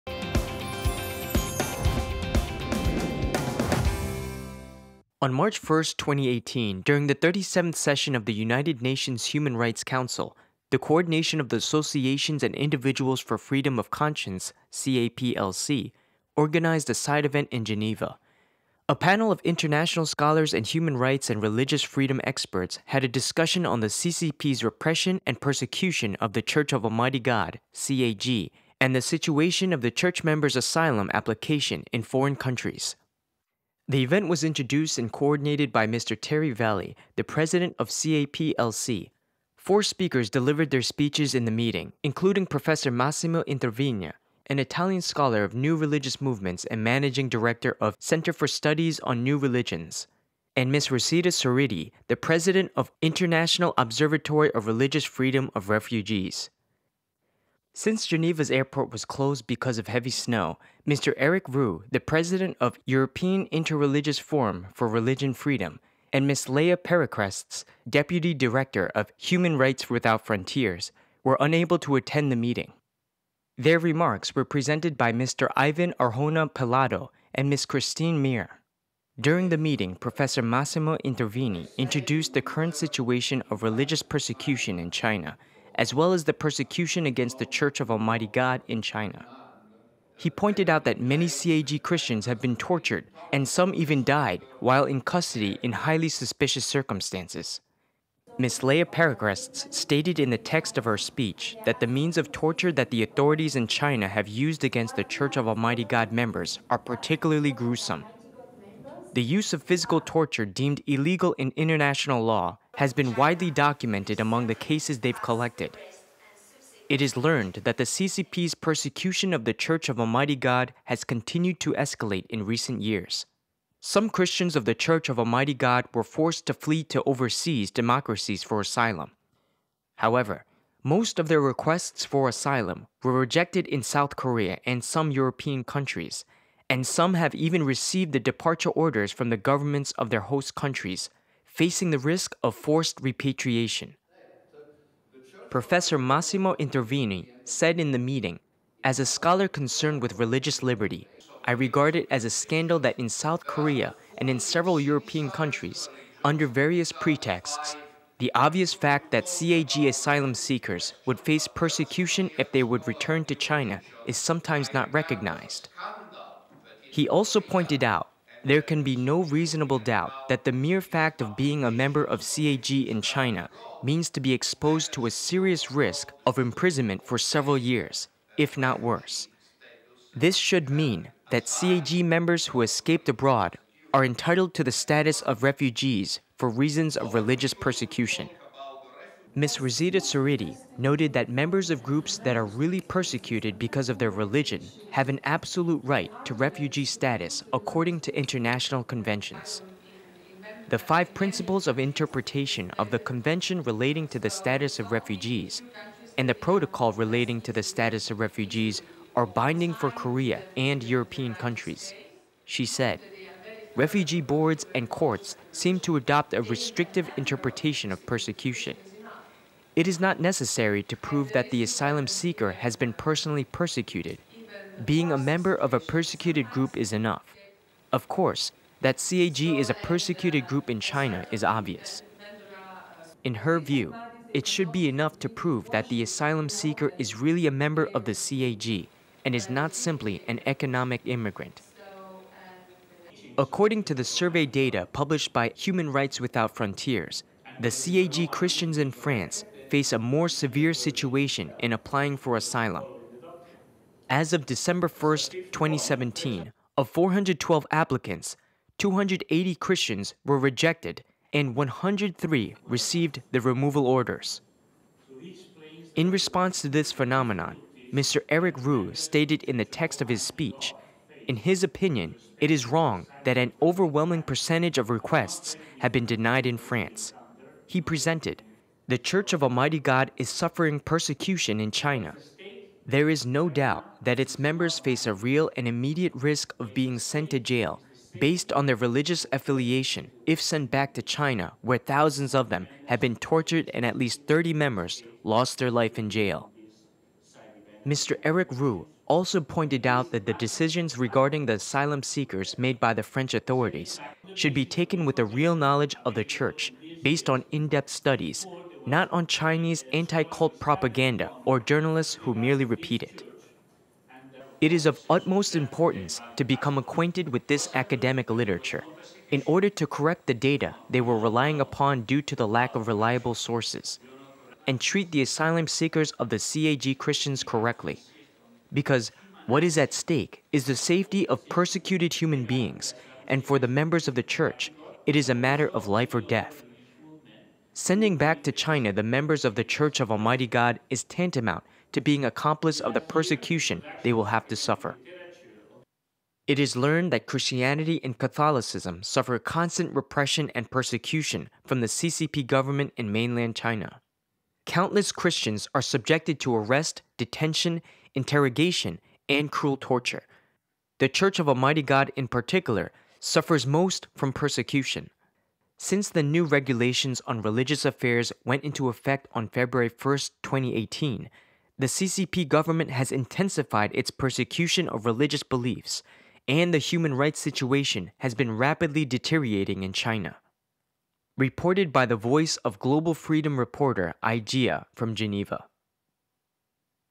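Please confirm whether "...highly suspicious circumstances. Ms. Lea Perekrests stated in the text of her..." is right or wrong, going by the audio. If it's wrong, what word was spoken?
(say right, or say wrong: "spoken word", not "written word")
right.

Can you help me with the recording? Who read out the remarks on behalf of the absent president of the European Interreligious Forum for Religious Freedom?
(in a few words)
Ivan Arjona Pelado.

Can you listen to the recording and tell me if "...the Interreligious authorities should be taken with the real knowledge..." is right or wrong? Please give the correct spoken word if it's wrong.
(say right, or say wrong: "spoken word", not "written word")
wrong: "French", not "Interreligious".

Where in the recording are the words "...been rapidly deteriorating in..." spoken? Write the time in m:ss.
6:18.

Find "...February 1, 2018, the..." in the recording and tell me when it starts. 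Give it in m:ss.
6:09.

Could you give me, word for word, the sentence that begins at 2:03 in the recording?
Some Christians of the Church of Almighty God were forced to flee to overseas democracies for asylum.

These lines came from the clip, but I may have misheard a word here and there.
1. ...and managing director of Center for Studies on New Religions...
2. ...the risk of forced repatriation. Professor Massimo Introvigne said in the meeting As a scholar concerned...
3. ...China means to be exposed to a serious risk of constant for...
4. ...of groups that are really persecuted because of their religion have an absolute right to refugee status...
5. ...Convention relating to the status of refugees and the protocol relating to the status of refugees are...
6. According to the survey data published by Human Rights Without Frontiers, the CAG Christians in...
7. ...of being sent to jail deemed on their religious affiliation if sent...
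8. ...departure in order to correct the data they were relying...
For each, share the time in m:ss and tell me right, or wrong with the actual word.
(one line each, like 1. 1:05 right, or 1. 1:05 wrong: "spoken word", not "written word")
1. 0:46 right
2. 2:21 right
3. 2:53 wrong: "imprisonment", not "constant"
4. 3:11 right
5. 3:22 right
6. 4:03 right
7. 4:46 wrong: "based", not "deemed"
8. 5:18 wrong: "literature", not "departure".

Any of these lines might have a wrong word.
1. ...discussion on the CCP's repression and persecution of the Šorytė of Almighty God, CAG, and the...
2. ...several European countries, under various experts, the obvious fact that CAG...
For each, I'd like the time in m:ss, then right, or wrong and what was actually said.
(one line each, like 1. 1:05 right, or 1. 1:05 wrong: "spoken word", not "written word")
1. 0:23 wrong: "Church", not "Šorytė"
2. 2:34 wrong: "pretexts", not "experts".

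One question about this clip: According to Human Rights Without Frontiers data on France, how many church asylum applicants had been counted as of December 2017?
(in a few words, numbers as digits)
412.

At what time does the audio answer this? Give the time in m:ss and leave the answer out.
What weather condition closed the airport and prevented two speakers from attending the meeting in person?
0:59.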